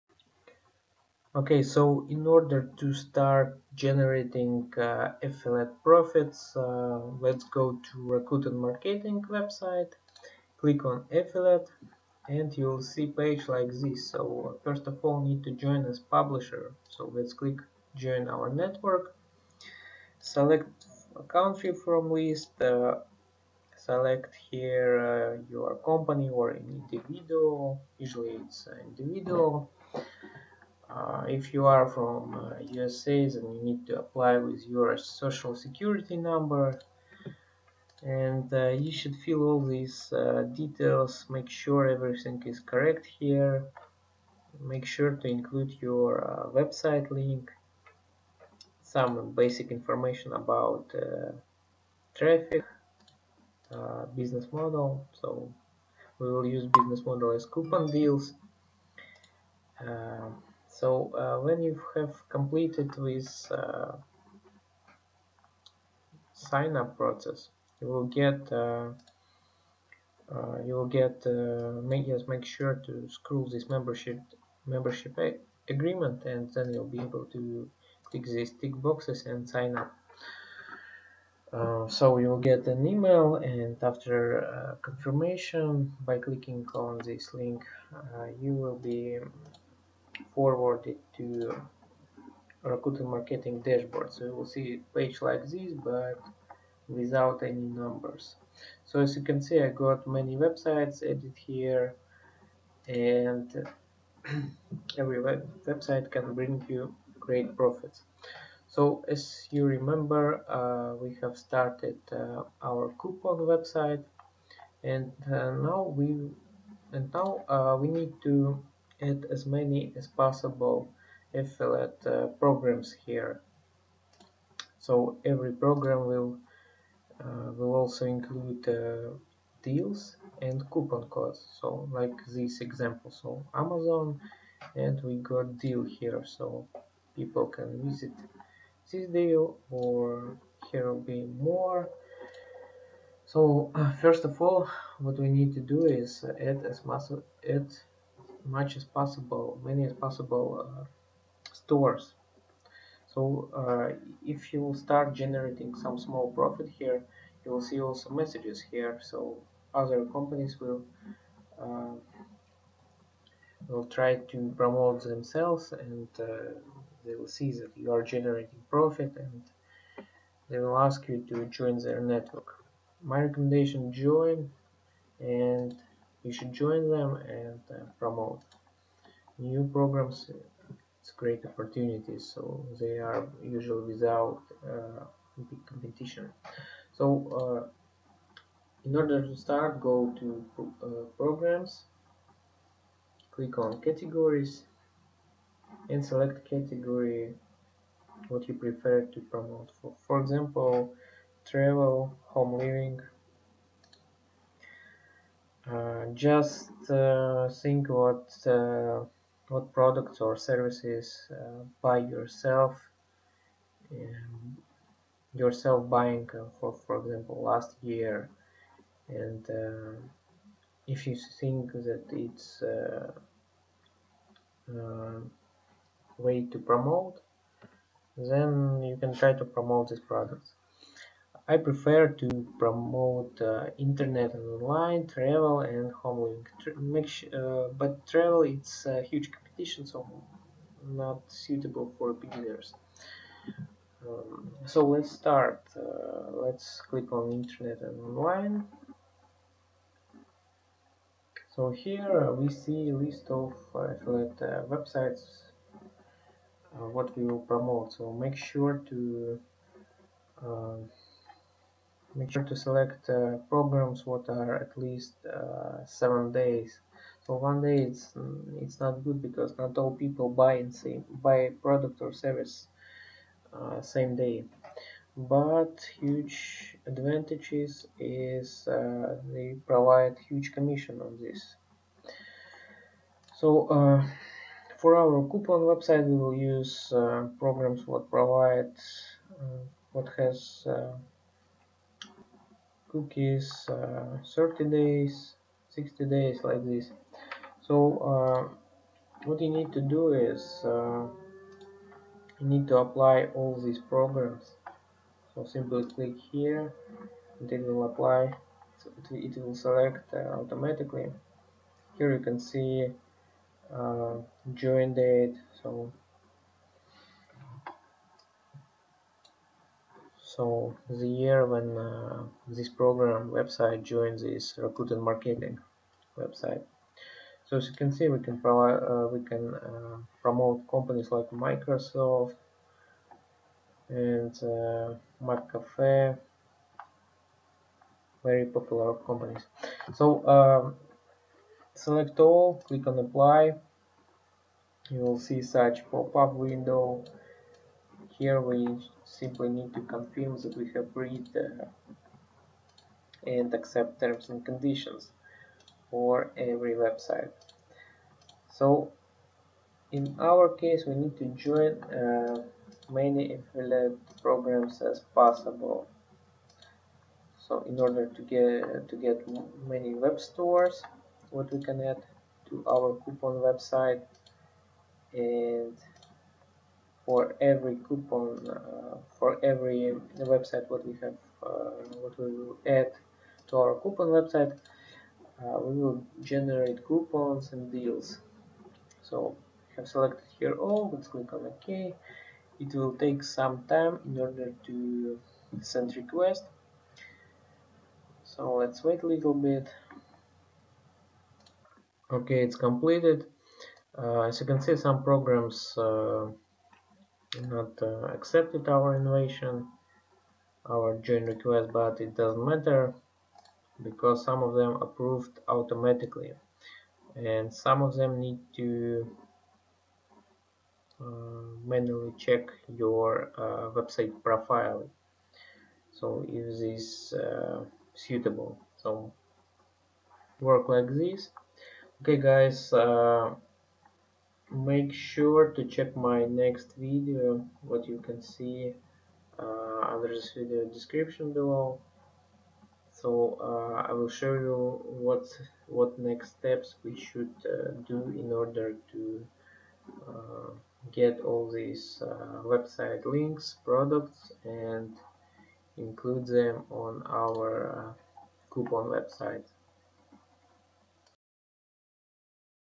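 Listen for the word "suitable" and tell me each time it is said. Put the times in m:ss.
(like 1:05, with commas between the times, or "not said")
4:01, 7:07.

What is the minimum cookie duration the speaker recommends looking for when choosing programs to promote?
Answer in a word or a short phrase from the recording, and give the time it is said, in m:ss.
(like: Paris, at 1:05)
7 days, at 4:25.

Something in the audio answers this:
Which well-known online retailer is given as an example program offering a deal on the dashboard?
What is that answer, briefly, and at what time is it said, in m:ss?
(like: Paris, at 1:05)
Amazon, at 2:13.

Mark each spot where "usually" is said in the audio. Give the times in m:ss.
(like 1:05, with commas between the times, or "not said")
0:27, 3:03.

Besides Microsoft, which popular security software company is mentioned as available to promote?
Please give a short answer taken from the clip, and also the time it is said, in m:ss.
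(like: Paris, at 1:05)
McAfee, at 5:35.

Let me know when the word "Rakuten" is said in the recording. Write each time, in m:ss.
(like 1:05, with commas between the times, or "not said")
0:08, 1:32, 5:24.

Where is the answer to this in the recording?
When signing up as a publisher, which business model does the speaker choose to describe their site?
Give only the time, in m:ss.
0:57.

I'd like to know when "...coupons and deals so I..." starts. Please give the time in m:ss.
6:26.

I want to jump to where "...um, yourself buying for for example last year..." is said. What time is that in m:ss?
3:33.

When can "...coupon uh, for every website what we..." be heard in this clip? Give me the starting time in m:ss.
6:17.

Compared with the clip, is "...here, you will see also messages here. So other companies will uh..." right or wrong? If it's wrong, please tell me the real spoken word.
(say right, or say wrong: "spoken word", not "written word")
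right.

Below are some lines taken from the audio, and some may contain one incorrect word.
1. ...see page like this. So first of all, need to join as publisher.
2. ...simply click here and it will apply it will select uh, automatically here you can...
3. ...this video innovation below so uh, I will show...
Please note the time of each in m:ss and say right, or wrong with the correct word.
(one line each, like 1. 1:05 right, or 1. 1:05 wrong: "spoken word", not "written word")
1. 0:12 right
2. 5:05 right
3. 7:20 wrong: "description", not "innovation".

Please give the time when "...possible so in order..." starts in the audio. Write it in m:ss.
6:05.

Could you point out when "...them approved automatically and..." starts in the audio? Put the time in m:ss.
6:54.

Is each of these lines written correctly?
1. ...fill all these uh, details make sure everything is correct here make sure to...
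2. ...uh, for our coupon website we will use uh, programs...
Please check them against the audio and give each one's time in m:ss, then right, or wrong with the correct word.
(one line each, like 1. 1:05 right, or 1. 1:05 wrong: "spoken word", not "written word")
1. 0:39 right
2. 4:43 right.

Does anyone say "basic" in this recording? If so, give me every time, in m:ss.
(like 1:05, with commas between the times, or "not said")
0:49.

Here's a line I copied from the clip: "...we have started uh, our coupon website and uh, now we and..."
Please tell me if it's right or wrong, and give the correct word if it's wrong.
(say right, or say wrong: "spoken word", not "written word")
right.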